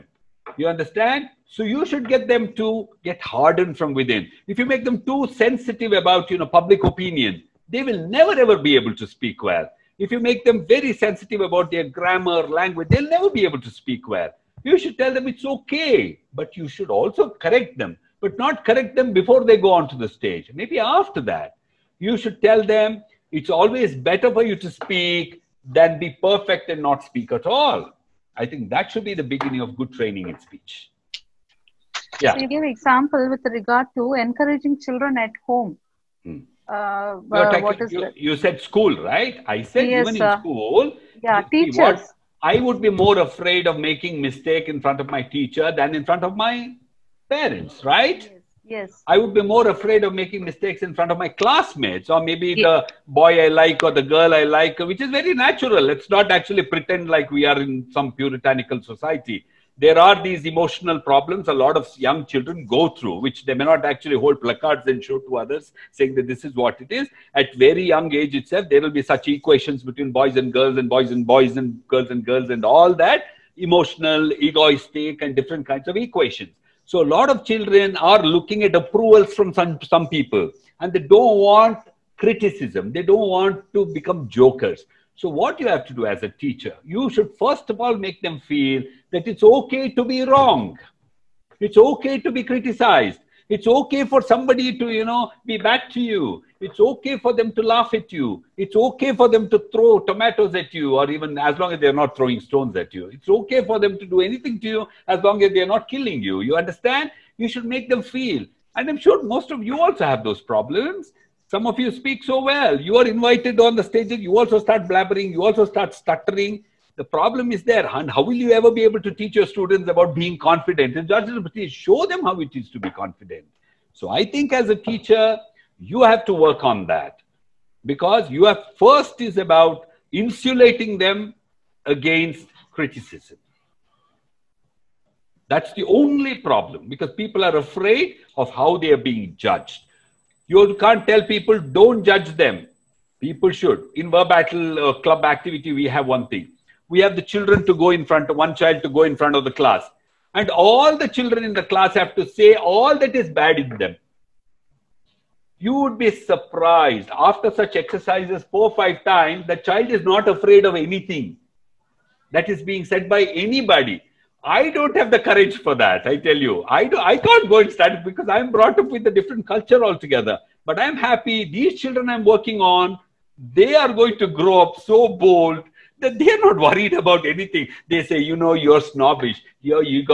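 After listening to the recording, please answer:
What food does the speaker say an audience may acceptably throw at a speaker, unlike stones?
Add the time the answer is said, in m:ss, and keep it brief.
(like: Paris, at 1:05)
tomatoes, at 1:39.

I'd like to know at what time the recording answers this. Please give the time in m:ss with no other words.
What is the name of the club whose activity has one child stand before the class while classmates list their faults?
2:24.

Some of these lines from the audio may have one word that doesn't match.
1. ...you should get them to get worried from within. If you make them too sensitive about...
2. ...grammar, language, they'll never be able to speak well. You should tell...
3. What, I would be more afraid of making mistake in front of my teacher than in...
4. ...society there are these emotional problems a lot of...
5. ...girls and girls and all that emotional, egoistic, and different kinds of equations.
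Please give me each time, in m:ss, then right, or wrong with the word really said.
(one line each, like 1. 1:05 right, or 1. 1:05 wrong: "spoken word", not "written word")
1. 0:01 wrong: "hardened", not "worried"
2. 0:11 right
3. 0:41 right
4. 0:58 right
5. 1:11 right.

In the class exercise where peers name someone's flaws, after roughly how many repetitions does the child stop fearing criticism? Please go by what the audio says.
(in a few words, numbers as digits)
4 or 5 times.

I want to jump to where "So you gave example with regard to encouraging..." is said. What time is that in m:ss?
0:32.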